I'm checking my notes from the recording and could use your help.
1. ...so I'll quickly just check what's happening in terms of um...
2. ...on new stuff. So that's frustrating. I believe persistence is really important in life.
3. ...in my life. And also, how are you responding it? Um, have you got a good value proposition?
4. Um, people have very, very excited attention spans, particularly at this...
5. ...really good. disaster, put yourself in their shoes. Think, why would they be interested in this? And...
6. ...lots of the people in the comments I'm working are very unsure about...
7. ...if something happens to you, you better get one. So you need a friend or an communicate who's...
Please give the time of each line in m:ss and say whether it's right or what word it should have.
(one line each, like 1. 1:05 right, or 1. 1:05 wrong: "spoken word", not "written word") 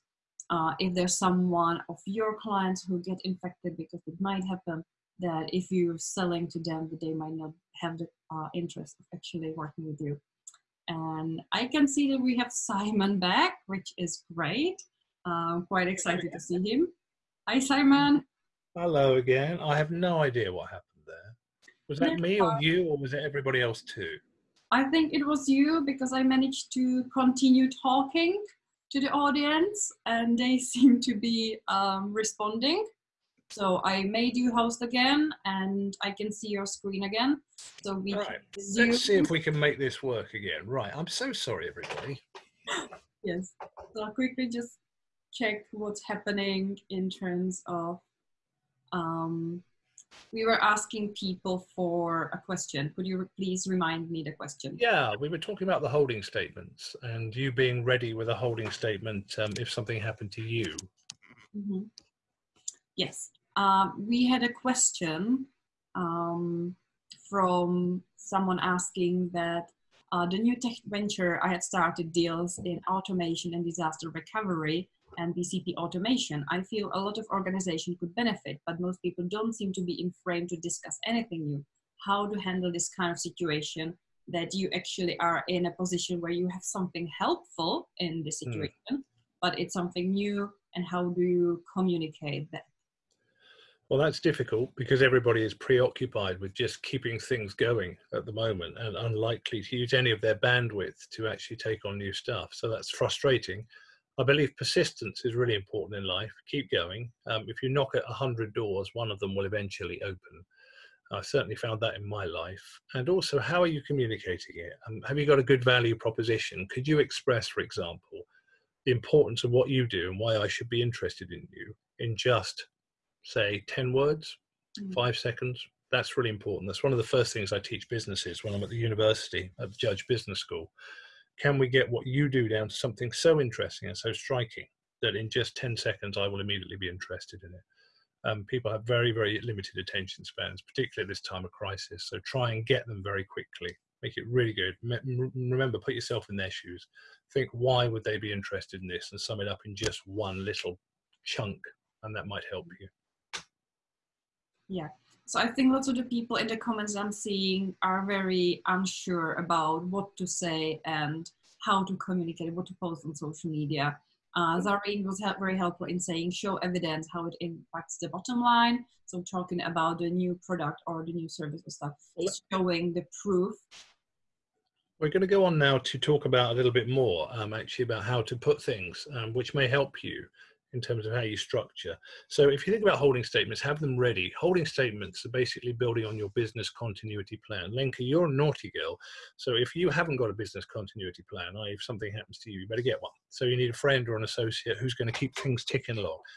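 1. 0:43 right
2. 1:41 right
3. 1:51 wrong: "communicating", not "responding"
4. 2:18 wrong: "limited", not "excited"
5. 2:24 wrong: "remember", not "disaster"
6. 2:35 wrong: "seeing", not "working"
7. 3:11 wrong: "associate", not "communicate".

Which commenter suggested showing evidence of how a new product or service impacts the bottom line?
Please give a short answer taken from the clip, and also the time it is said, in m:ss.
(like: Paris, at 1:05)
Zareen, at 2:44.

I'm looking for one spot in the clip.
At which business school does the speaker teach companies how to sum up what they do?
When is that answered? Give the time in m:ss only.
2:09.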